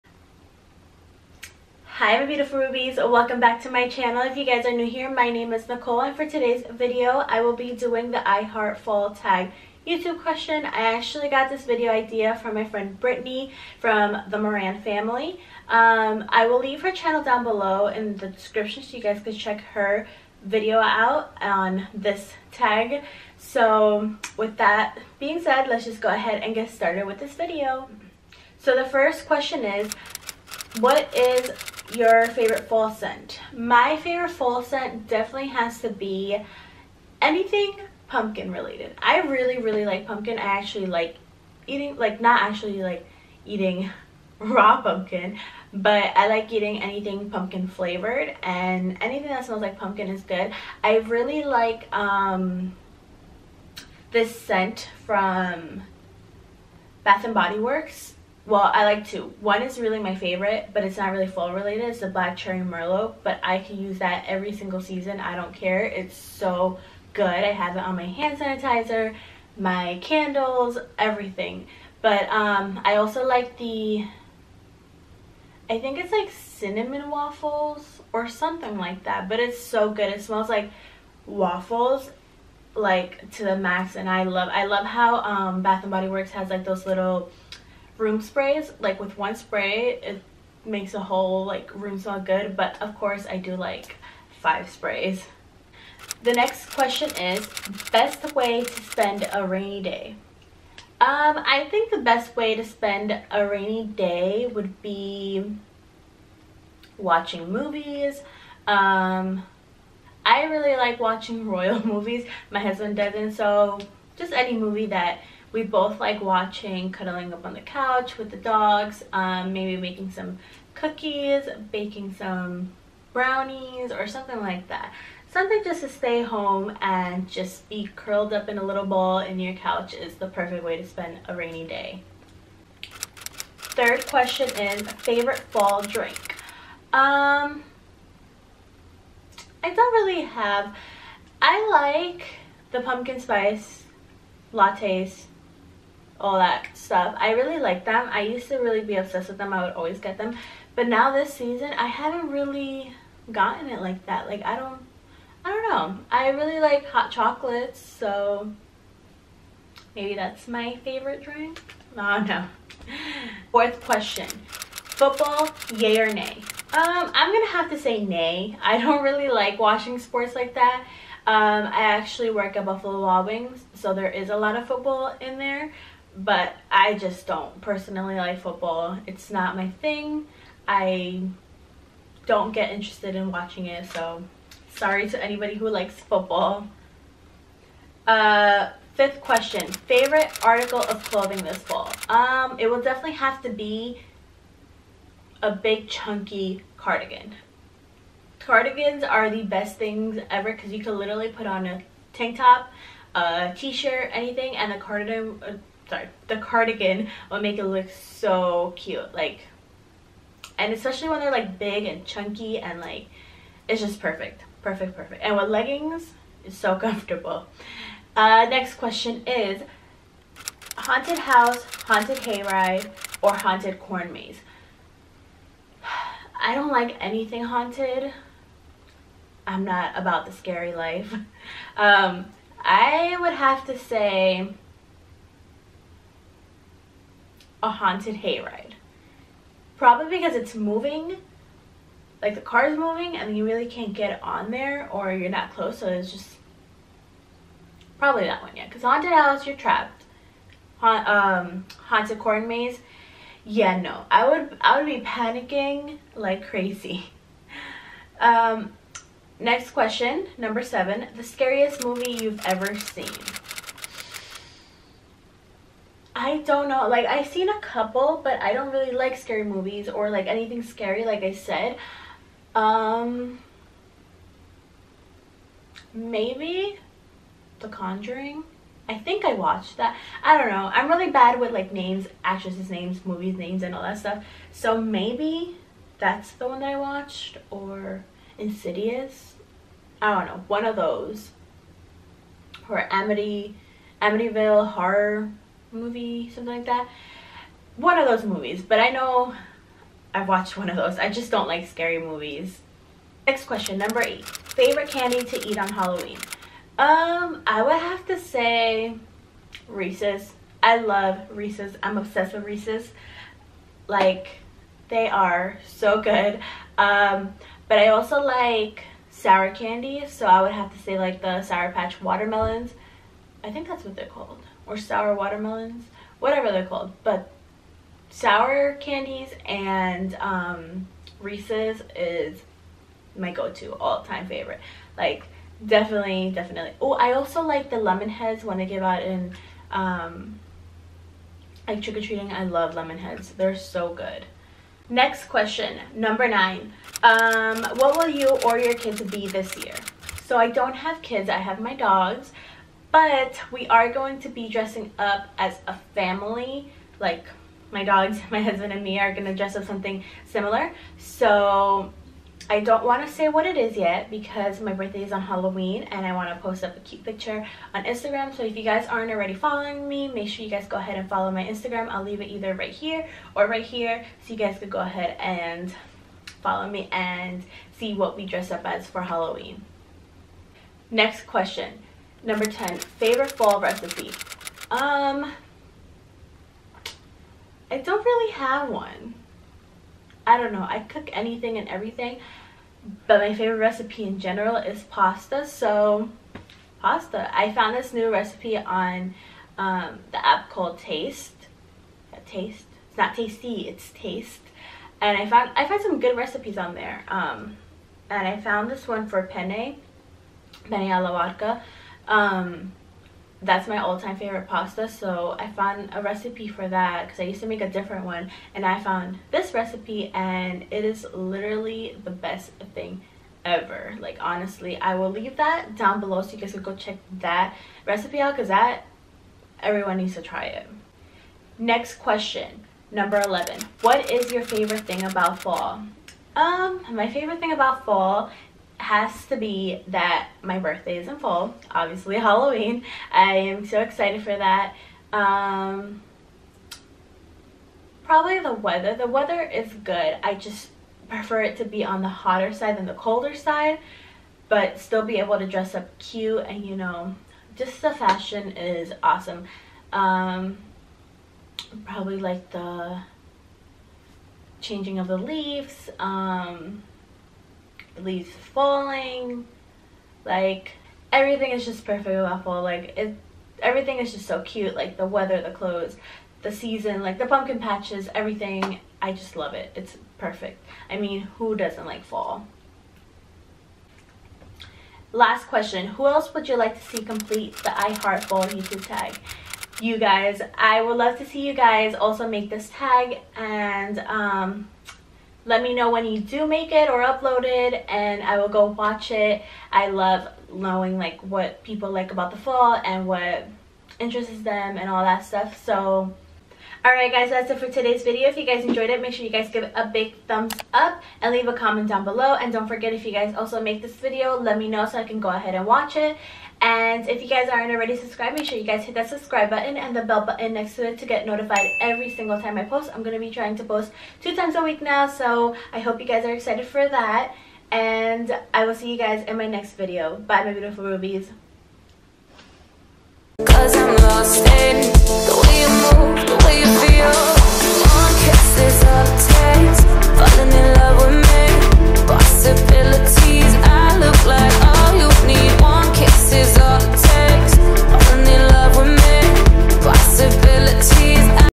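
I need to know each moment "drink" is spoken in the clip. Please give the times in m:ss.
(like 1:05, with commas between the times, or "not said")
2:15, 2:41.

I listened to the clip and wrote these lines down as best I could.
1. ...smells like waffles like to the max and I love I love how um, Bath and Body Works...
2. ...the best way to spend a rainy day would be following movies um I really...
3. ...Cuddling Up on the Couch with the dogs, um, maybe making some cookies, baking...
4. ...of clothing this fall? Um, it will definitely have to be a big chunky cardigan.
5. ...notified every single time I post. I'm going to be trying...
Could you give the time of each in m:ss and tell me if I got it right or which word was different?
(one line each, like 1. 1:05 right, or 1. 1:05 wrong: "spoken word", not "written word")
1. 1:20 right
2. 1:41 wrong: "watching", not "following"
3. 1:56 right
4. 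3:10 right
5. 8:41 right.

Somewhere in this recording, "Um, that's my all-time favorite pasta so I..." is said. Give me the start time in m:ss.
6:52.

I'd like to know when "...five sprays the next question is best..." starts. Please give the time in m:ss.
1:34.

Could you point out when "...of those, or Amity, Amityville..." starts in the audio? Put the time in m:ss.
4:50.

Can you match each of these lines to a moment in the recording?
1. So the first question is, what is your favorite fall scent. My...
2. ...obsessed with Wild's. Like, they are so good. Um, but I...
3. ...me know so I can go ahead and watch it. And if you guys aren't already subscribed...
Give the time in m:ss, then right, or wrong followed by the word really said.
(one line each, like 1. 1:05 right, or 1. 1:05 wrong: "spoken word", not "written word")
1. 0:28 right
2. 5:11 wrong: "Reese", not "Wild"
3. 8:34 right.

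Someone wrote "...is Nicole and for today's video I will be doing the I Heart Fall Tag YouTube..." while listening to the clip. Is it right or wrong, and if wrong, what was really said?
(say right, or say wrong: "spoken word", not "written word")
right.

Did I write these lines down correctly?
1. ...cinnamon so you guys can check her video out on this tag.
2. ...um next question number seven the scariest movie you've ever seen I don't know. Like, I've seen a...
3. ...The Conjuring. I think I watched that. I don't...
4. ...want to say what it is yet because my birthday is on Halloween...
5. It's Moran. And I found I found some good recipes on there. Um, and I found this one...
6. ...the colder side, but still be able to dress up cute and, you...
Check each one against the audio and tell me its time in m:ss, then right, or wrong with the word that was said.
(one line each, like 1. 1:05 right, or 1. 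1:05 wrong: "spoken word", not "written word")
1. 0:18 wrong: "description", not "cinnamon"
2. 4:18 right
3. 4:37 right
4. 6:02 right
5. 6:43 wrong: "Taste", not "Moran"
6. 7:32 right.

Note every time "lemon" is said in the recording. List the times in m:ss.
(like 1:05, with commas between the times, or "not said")
5:37, 5:42.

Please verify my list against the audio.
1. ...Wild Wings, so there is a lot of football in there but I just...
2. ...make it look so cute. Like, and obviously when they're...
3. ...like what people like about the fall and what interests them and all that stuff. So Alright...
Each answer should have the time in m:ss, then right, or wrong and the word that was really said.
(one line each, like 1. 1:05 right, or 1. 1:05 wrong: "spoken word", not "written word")
1. 2:53 right
2. 3:27 wrong: "especially", not "obviously"
3. 8:20 right.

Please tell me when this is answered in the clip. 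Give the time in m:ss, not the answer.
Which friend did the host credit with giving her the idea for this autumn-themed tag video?
0:12.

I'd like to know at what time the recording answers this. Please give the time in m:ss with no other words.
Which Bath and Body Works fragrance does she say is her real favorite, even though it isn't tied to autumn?
1:02.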